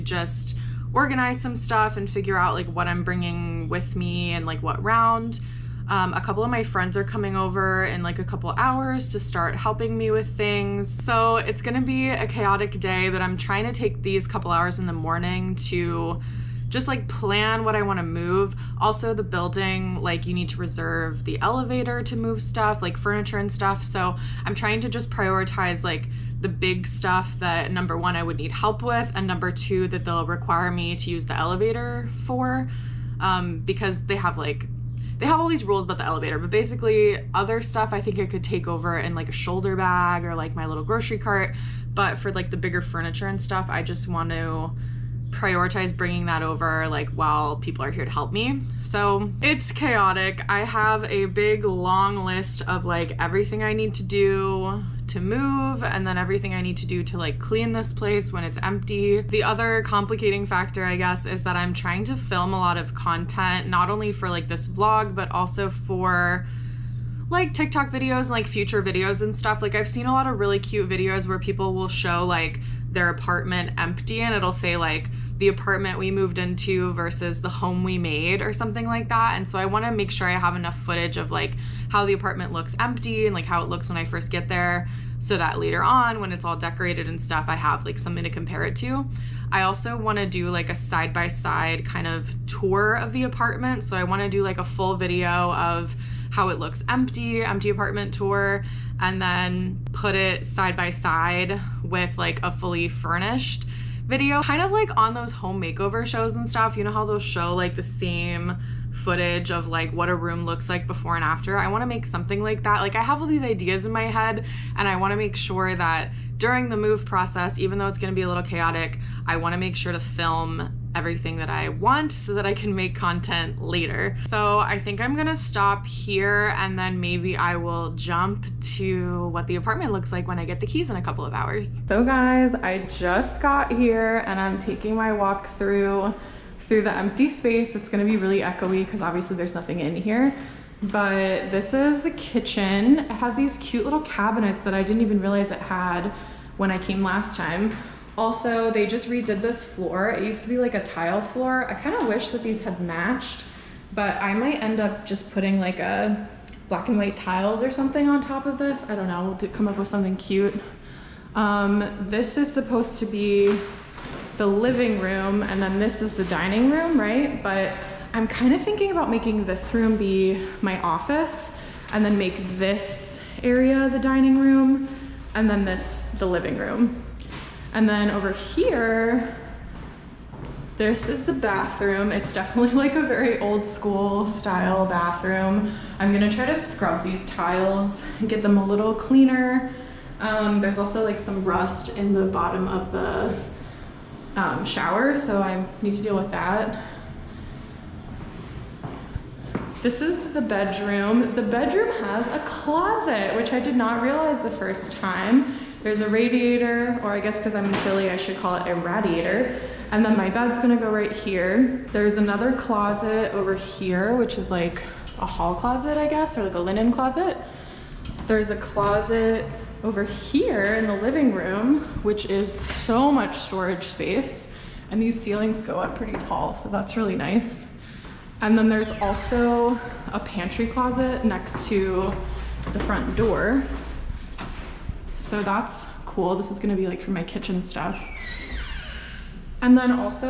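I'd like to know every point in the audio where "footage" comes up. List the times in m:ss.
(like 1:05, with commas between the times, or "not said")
1:20, 1:49.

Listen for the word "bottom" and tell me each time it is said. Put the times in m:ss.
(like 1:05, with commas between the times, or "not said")
3:12.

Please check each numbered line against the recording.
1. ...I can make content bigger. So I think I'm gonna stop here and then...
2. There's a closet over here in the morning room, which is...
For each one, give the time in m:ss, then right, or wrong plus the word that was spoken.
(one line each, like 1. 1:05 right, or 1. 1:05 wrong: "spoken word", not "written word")
1. 2:02 wrong: "later", not "bigger"
2. 3:38 wrong: "living", not "morning".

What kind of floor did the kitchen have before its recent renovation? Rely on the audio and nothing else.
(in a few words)
Tile floor.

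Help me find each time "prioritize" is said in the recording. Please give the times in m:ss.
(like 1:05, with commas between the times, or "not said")
0:25, 0:45.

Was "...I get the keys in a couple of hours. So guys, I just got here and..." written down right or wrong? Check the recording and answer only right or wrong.
right.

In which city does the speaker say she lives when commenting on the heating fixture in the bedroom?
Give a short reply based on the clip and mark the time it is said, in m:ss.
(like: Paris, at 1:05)
Philly, at 3:27.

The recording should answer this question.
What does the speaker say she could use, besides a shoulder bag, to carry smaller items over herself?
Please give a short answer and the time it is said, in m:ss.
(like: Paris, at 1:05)
Grocery cart, at 0:40.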